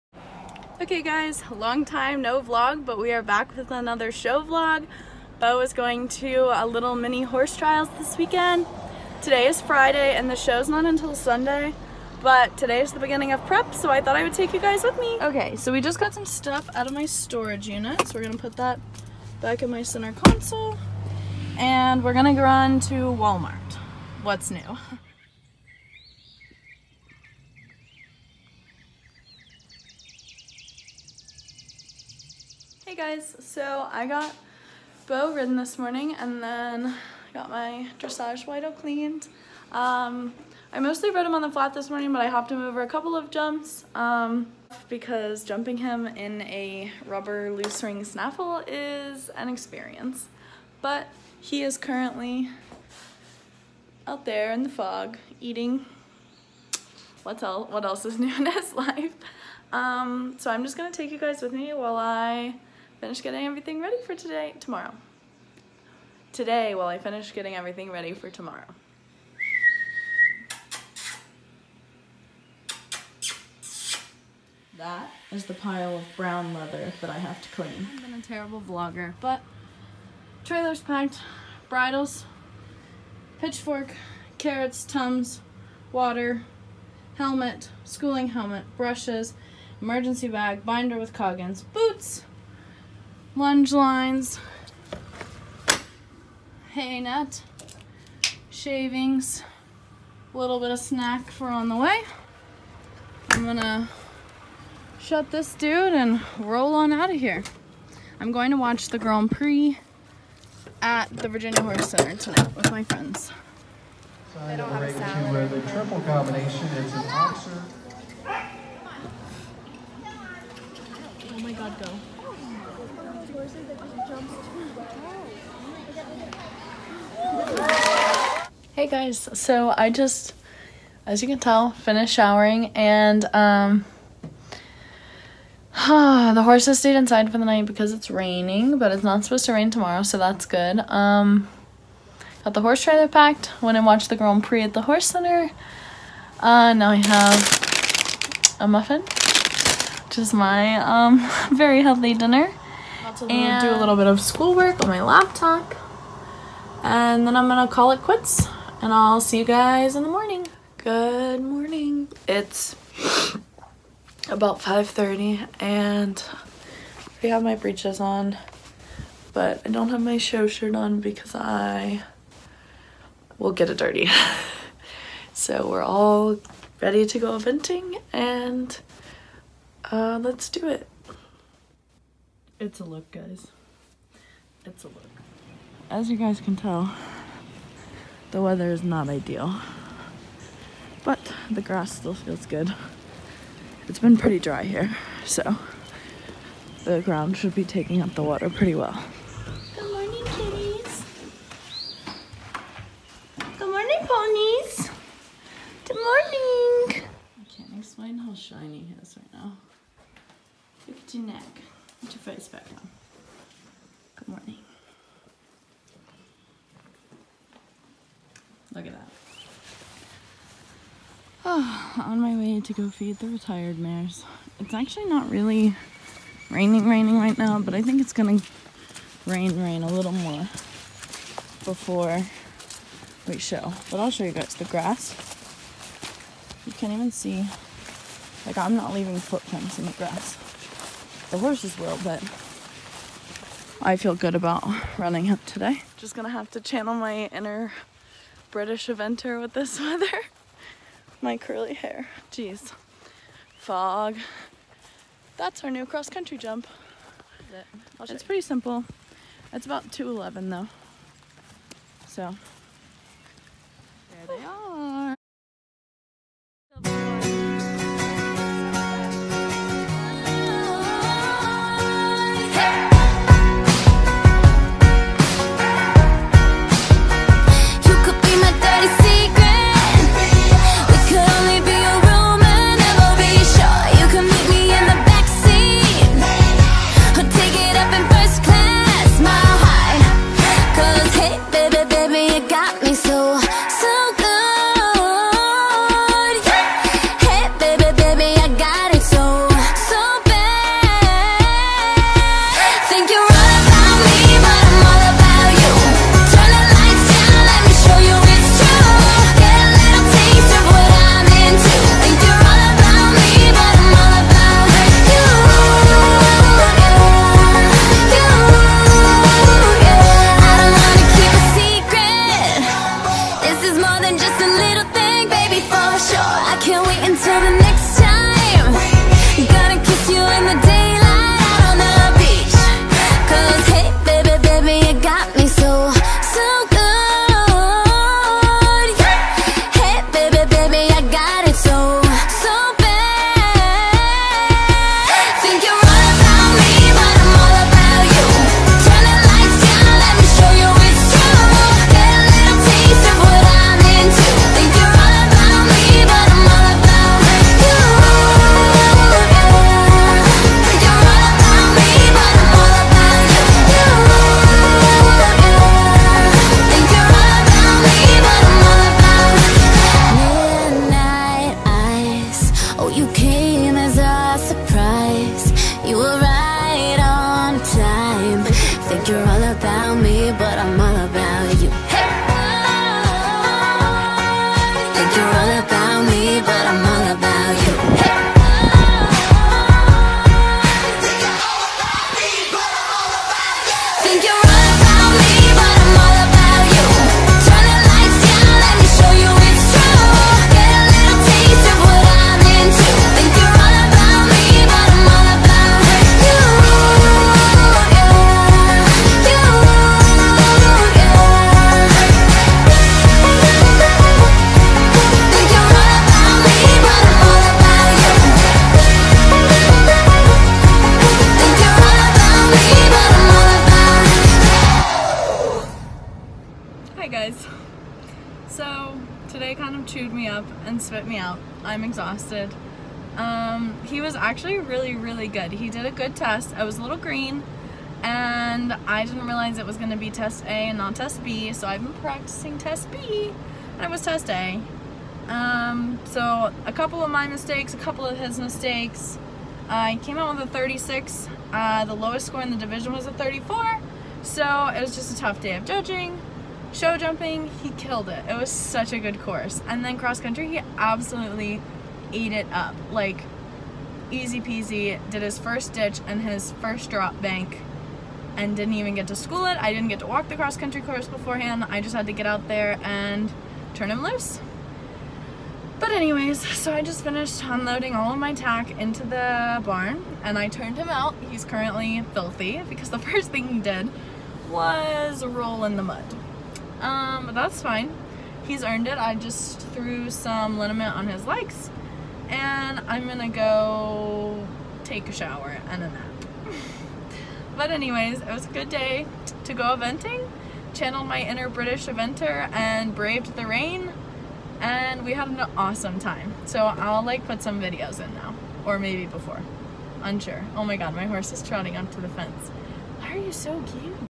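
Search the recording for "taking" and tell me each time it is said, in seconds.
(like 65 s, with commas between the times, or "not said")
197 s.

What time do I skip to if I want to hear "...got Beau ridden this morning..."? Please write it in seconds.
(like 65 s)
34 s.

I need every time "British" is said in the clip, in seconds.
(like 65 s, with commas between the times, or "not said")
248 s, 501 s.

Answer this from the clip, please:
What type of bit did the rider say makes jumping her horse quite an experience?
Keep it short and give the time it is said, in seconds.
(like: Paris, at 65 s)
Rubber loose ring snaffle, at 47 s.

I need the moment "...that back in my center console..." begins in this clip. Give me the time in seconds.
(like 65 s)
18 s.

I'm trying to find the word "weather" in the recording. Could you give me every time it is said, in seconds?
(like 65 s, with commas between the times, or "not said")
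188 s, 249 s.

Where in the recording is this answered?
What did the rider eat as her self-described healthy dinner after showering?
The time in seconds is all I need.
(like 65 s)
148 s.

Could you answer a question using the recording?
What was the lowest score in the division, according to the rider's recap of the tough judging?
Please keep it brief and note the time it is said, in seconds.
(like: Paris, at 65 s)
34, at 453 s.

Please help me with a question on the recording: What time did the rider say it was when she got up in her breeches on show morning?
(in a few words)
5:30.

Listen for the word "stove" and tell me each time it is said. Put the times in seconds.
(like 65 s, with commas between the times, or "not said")
not said.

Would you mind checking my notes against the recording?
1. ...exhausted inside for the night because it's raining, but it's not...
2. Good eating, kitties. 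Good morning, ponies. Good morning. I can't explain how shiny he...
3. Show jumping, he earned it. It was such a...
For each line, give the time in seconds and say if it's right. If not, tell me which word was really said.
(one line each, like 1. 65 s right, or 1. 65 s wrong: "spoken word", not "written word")
1. 136 s wrong: "stayed", not "exhausted"
2. 199 s wrong: "morning", not "eating"
3. 456 s wrong: "killed", not "earned".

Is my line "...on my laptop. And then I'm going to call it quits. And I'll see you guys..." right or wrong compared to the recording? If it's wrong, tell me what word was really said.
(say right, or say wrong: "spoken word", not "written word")
right.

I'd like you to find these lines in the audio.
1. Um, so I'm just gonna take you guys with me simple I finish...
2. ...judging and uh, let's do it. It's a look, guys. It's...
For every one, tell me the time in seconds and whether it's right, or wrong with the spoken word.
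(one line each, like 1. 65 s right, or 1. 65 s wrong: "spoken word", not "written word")
1. 59 s wrong: "while", not "simple"
2. 177 s wrong: "eventing", not "judging".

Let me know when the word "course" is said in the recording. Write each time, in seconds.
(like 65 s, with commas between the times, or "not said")
459 s, 470 s.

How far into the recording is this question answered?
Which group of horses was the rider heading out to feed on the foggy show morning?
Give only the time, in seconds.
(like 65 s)
223 s.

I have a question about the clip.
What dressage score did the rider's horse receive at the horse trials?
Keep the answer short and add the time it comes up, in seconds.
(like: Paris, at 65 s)
36, at 450 s.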